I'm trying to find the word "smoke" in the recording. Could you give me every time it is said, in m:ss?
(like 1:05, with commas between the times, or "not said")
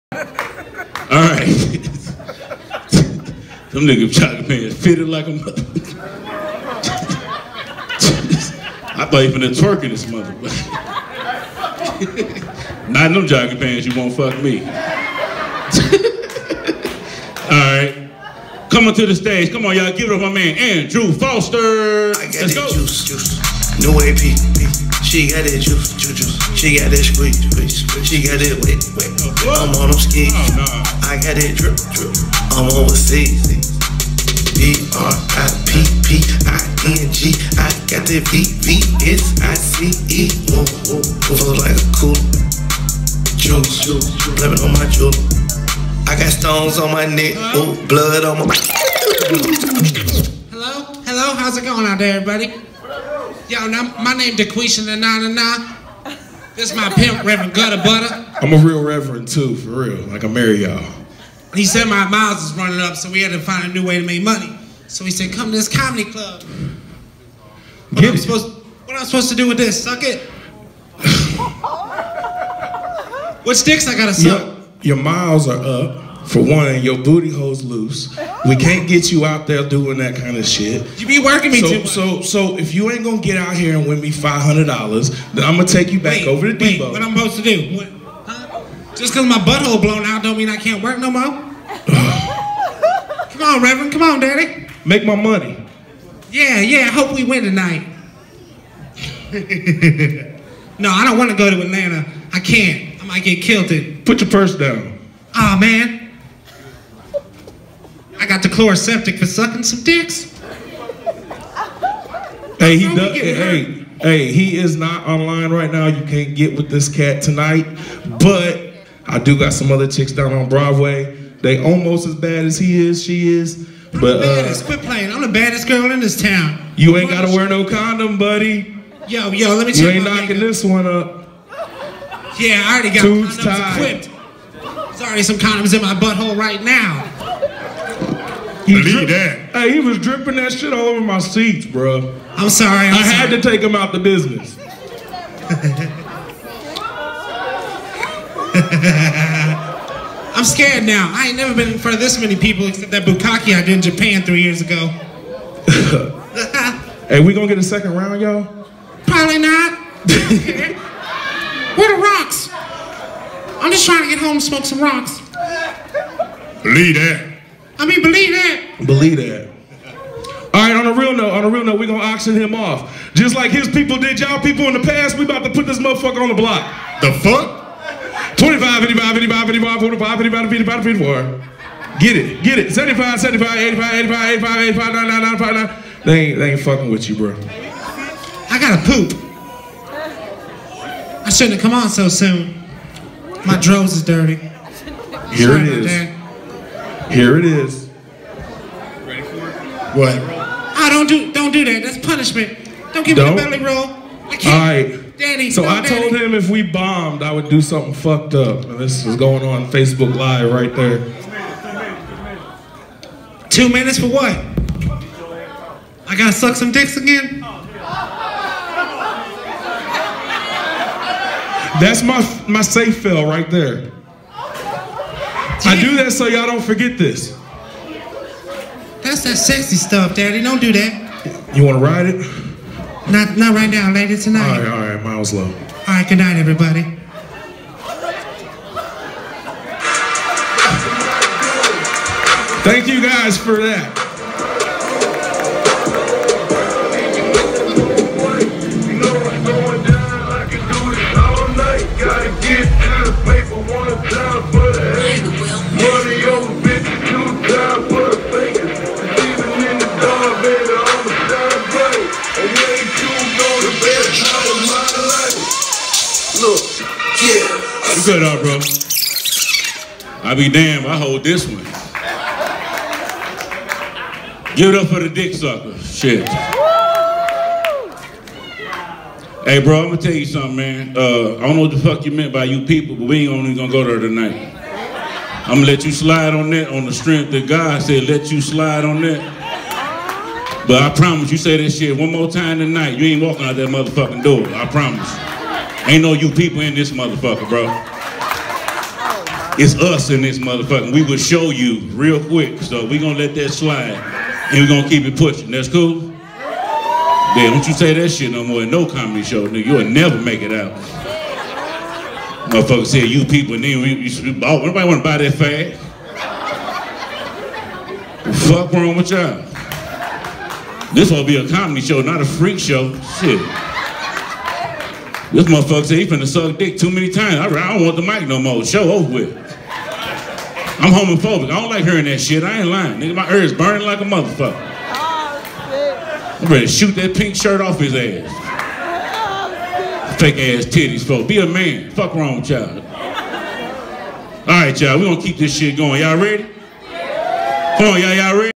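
2:44.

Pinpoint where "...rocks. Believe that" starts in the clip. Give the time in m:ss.
2:44.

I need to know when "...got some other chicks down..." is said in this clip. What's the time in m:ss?
1:59.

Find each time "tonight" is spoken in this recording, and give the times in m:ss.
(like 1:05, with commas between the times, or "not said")
1:37, 1:57, 3:54, 4:43, 4:52.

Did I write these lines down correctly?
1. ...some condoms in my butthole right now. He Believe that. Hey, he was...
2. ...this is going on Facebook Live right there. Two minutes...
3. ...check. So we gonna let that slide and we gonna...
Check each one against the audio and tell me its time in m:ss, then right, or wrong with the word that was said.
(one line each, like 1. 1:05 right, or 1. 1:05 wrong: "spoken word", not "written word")
1. 2:15 right
2. 3:28 right
3. 5:02 wrong: "quick", not "check".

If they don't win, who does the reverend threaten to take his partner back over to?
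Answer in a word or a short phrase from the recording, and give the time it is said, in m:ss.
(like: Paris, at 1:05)
Debo, at 1:26.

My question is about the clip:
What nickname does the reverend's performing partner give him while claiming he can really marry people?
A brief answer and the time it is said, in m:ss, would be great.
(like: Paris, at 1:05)
Reverend Gutta Butta, at 0:57.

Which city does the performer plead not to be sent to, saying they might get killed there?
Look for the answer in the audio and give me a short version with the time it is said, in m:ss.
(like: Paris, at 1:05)
Atlanta, at 1:41.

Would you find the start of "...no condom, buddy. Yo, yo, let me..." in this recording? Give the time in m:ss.
2:07.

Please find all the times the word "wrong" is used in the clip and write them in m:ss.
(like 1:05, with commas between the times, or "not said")
5:18, 5:42.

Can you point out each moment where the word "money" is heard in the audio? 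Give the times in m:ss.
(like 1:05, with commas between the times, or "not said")
1:04, 1:35.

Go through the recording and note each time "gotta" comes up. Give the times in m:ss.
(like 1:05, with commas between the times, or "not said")
1:13, 2:07, 3:08, 3:36.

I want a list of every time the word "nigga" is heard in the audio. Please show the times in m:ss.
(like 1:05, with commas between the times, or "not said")
0:03, 5:09, 5:32.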